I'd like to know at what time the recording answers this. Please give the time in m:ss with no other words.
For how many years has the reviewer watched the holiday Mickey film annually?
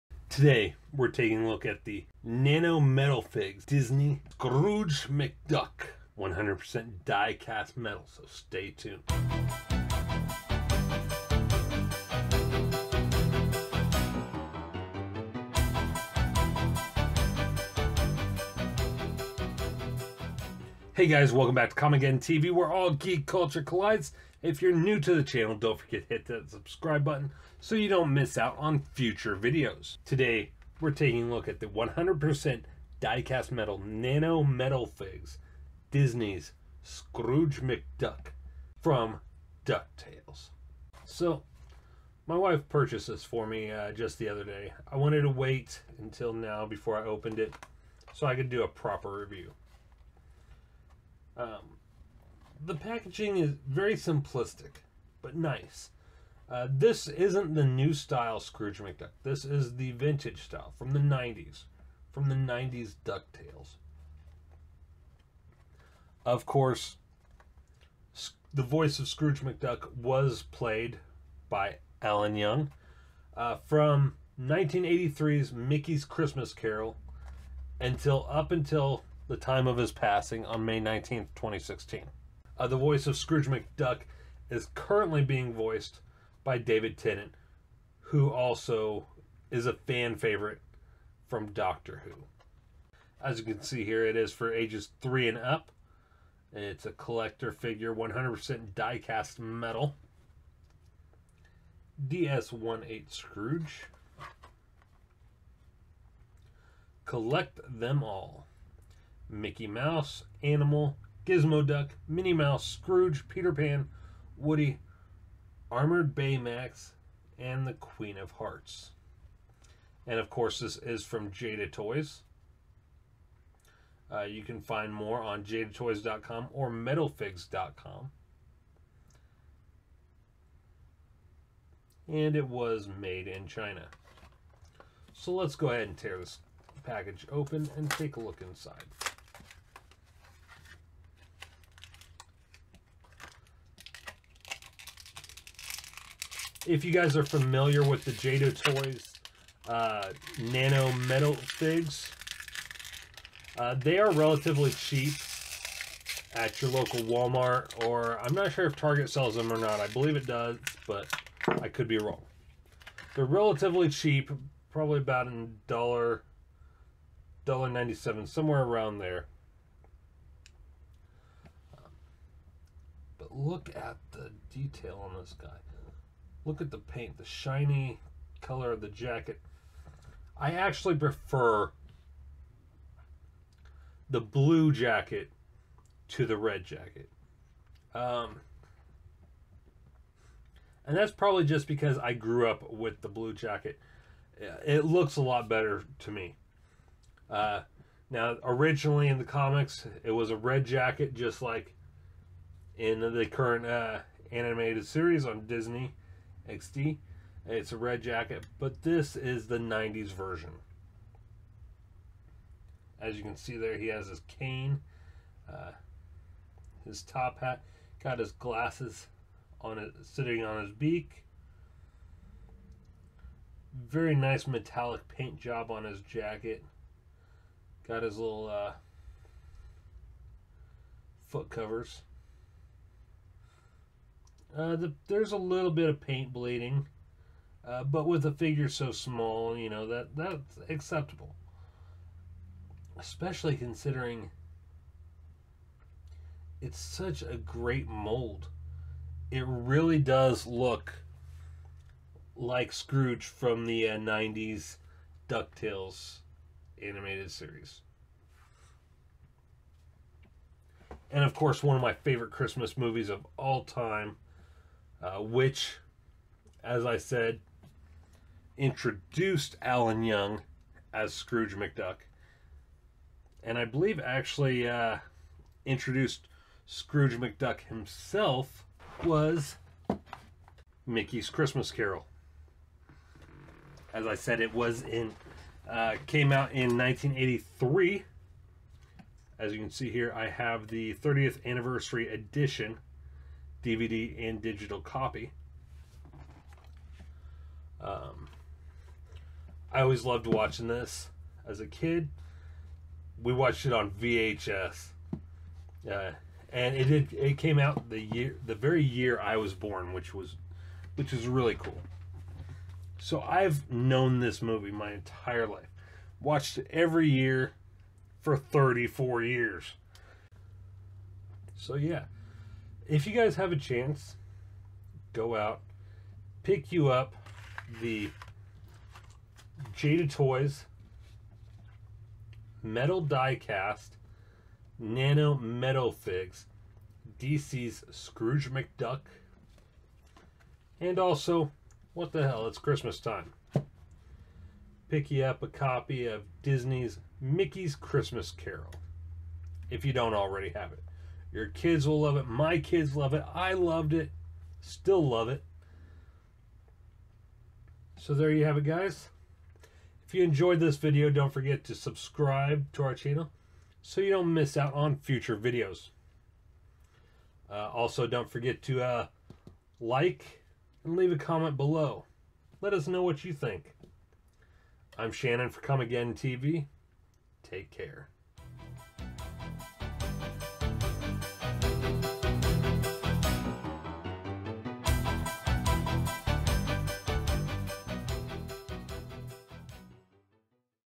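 5:18.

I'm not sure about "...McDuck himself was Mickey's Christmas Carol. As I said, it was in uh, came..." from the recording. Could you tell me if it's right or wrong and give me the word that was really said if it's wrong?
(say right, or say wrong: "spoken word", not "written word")
right.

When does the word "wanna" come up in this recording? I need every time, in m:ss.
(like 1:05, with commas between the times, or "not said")
not said.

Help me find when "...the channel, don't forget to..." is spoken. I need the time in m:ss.
0:25.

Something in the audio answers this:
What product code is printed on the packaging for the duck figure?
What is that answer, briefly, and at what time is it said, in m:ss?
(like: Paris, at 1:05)
DS-18, at 1:42.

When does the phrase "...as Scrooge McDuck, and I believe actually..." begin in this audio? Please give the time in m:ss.
4:30.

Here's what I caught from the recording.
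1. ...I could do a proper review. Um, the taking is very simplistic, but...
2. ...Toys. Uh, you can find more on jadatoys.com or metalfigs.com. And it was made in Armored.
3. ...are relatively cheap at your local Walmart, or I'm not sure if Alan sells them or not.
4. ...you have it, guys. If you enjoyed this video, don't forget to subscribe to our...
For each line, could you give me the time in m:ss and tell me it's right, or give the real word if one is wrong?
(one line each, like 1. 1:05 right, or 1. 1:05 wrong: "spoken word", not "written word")
1. 0:48 wrong: "packaging", not "taking"
2. 2:01 wrong: "China", not "Armored"
3. 2:33 wrong: "Target", not "Alan"
4. 5:58 right.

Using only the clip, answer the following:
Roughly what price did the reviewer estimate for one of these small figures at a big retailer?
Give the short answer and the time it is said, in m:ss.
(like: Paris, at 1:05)
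$1.97, at 2:47.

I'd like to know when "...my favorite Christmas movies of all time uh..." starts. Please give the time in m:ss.
4:21.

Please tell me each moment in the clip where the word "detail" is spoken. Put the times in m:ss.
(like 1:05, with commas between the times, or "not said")
2:54.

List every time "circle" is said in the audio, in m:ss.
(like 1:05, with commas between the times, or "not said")
not said.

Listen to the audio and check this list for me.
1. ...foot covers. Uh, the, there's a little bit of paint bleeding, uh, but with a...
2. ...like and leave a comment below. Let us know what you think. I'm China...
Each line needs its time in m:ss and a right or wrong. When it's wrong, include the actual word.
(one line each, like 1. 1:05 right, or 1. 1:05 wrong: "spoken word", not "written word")
1. 3:51 right
2. 6:09 wrong: "Shannon", not "China".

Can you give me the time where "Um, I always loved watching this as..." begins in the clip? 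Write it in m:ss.
4:57.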